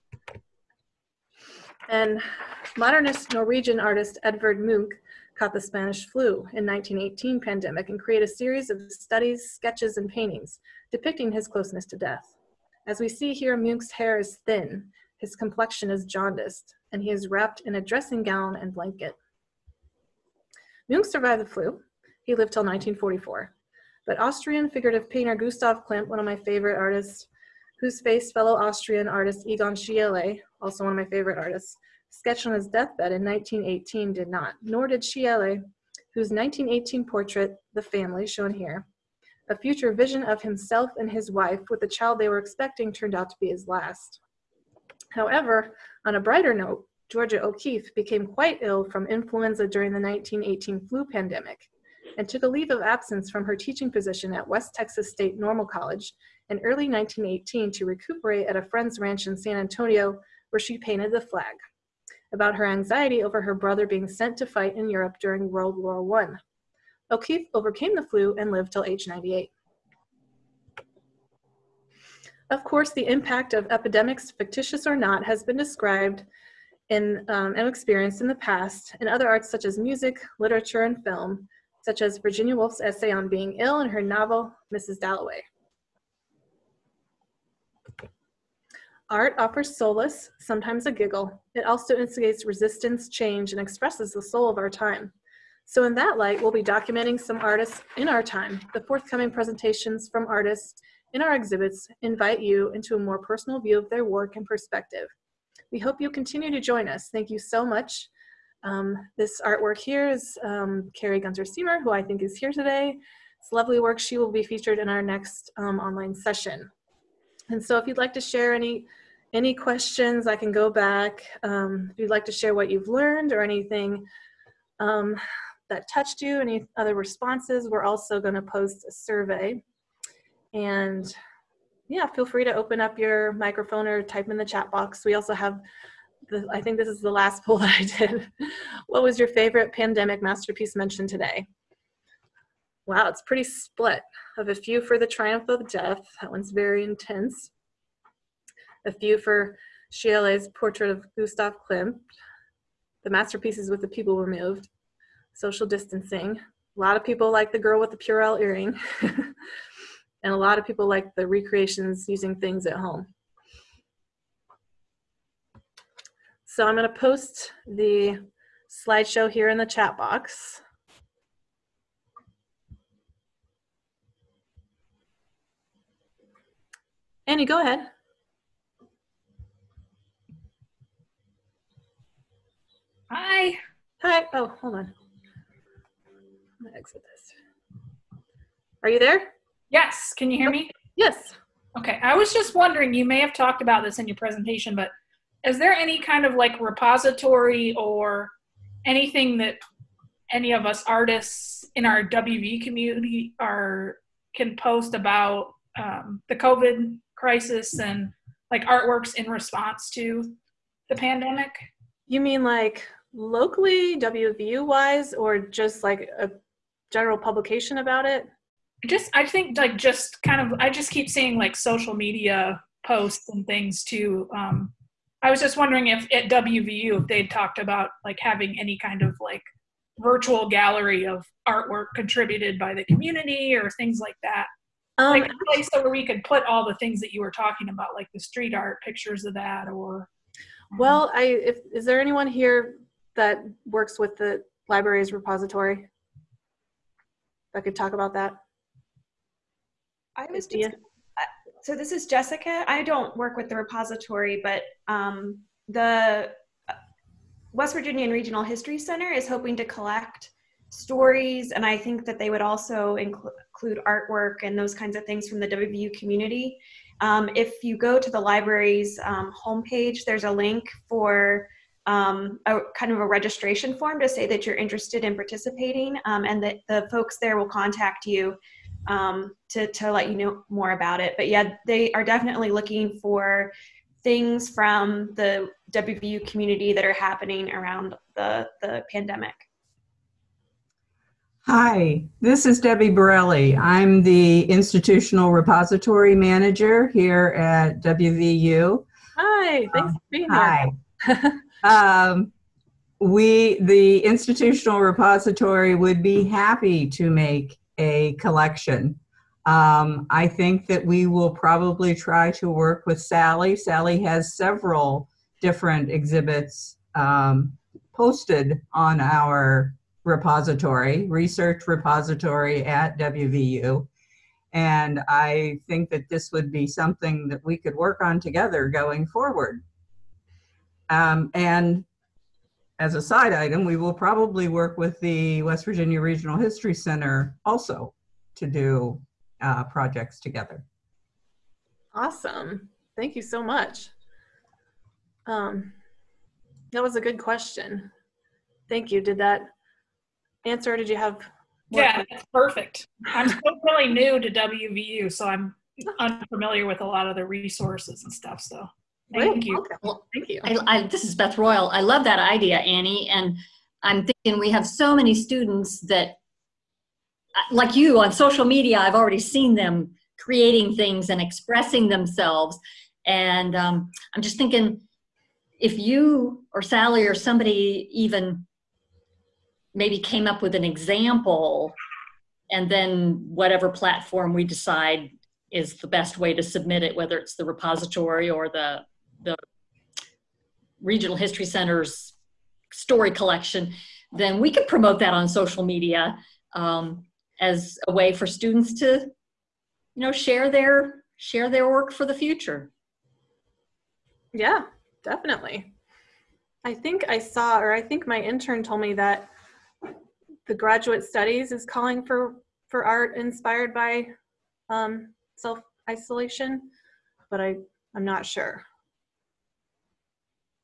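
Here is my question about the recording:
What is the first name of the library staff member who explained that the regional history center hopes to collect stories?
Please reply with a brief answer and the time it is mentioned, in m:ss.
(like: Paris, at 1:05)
Jessica, at 4:12.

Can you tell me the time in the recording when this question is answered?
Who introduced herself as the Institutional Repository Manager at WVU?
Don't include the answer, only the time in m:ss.
4:52.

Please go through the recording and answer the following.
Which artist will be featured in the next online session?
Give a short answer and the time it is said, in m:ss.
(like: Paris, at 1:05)
Kari Gunter Seymour, at 1:50.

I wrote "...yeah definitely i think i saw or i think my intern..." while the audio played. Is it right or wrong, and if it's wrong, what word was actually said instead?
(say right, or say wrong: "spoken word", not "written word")
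right.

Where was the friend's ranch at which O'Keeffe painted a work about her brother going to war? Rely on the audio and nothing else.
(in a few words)
San Antonio.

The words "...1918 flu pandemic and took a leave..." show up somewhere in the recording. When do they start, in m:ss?
0:49.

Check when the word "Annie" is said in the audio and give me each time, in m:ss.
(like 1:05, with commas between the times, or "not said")
2:57, 6:02.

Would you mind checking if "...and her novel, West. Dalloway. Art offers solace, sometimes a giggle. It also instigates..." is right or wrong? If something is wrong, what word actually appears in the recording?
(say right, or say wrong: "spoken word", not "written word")
wrong: "Mrs", not "West".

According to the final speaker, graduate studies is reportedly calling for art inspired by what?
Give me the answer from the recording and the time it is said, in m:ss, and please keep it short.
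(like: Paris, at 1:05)
self isolation, at 6:55.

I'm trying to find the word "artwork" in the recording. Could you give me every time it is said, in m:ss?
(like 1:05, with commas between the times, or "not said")
1:49, 3:28, 3:51, 4:23.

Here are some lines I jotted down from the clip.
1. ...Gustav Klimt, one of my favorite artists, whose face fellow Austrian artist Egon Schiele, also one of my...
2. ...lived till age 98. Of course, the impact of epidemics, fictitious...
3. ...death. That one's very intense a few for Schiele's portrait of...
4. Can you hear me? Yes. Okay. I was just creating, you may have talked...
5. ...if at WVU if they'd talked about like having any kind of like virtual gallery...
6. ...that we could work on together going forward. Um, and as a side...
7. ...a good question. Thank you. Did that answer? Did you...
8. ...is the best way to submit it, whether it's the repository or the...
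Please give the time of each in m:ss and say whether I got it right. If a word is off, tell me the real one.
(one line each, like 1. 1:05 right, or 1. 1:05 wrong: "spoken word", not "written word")
1. 0:25 right
2. 1:08 right
3. 2:25 right
4. 3:10 wrong: "wondering", not "creating"
5. 3:45 right
6. 5:27 right
7. 5:46 right
8. 6:25 right.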